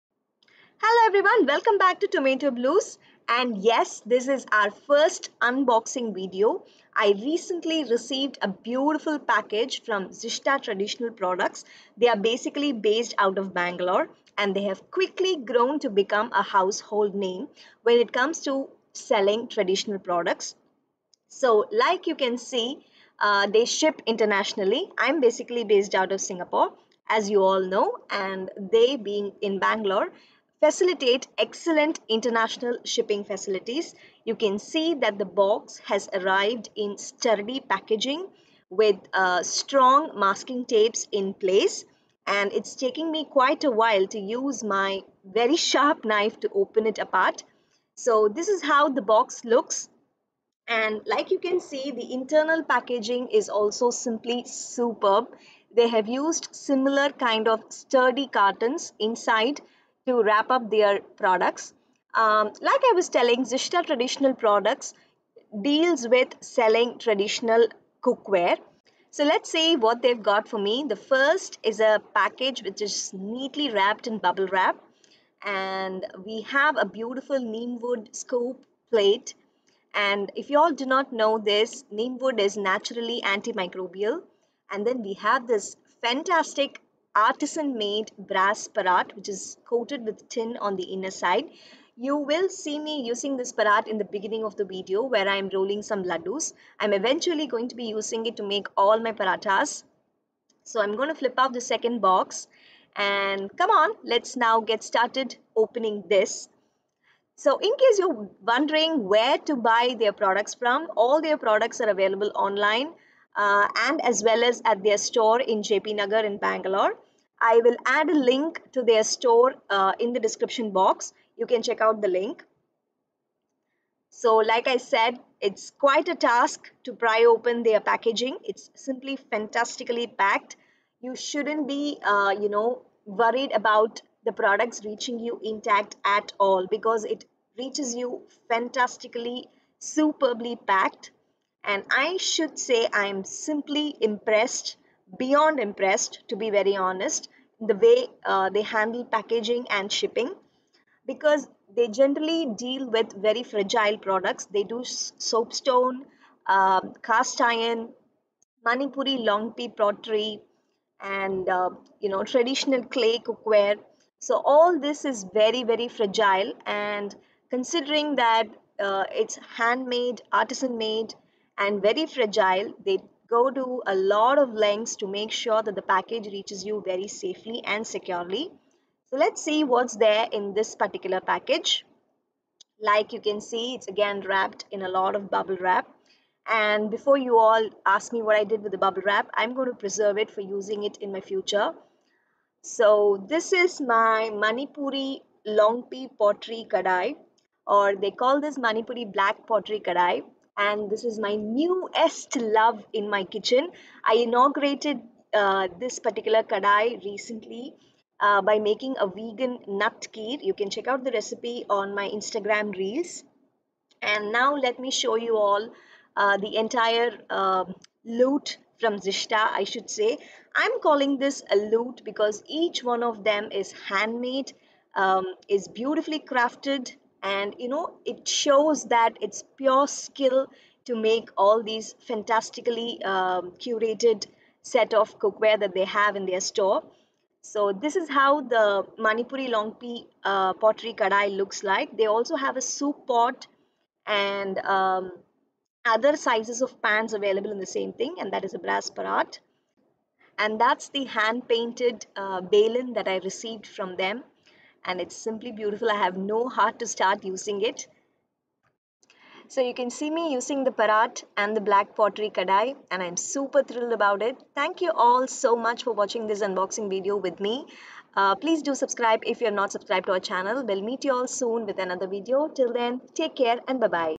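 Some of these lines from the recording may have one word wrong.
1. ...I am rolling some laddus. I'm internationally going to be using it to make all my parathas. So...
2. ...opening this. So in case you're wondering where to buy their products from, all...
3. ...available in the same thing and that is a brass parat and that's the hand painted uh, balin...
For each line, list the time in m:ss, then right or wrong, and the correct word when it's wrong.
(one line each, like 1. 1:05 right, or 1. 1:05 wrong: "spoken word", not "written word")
1. 1:35 wrong: "eventually", not "internationally"
2. 1:45 right
3. 4:07 right.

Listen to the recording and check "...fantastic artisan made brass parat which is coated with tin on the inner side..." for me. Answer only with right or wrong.
right.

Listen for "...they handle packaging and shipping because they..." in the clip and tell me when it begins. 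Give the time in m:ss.
2:28.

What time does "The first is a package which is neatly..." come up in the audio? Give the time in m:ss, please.
1:10.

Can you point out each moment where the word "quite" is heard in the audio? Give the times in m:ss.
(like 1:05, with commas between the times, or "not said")
0:43, 2:05.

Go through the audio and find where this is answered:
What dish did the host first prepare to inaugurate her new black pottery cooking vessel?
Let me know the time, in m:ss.
3:29.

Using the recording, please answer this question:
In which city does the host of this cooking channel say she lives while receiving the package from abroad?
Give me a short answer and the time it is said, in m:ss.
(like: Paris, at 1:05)
Singapore, at 0:26.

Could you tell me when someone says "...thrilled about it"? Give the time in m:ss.
4:23.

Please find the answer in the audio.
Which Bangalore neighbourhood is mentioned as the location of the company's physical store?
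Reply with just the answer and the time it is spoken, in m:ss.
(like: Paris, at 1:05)
JP Nagar, at 1:55.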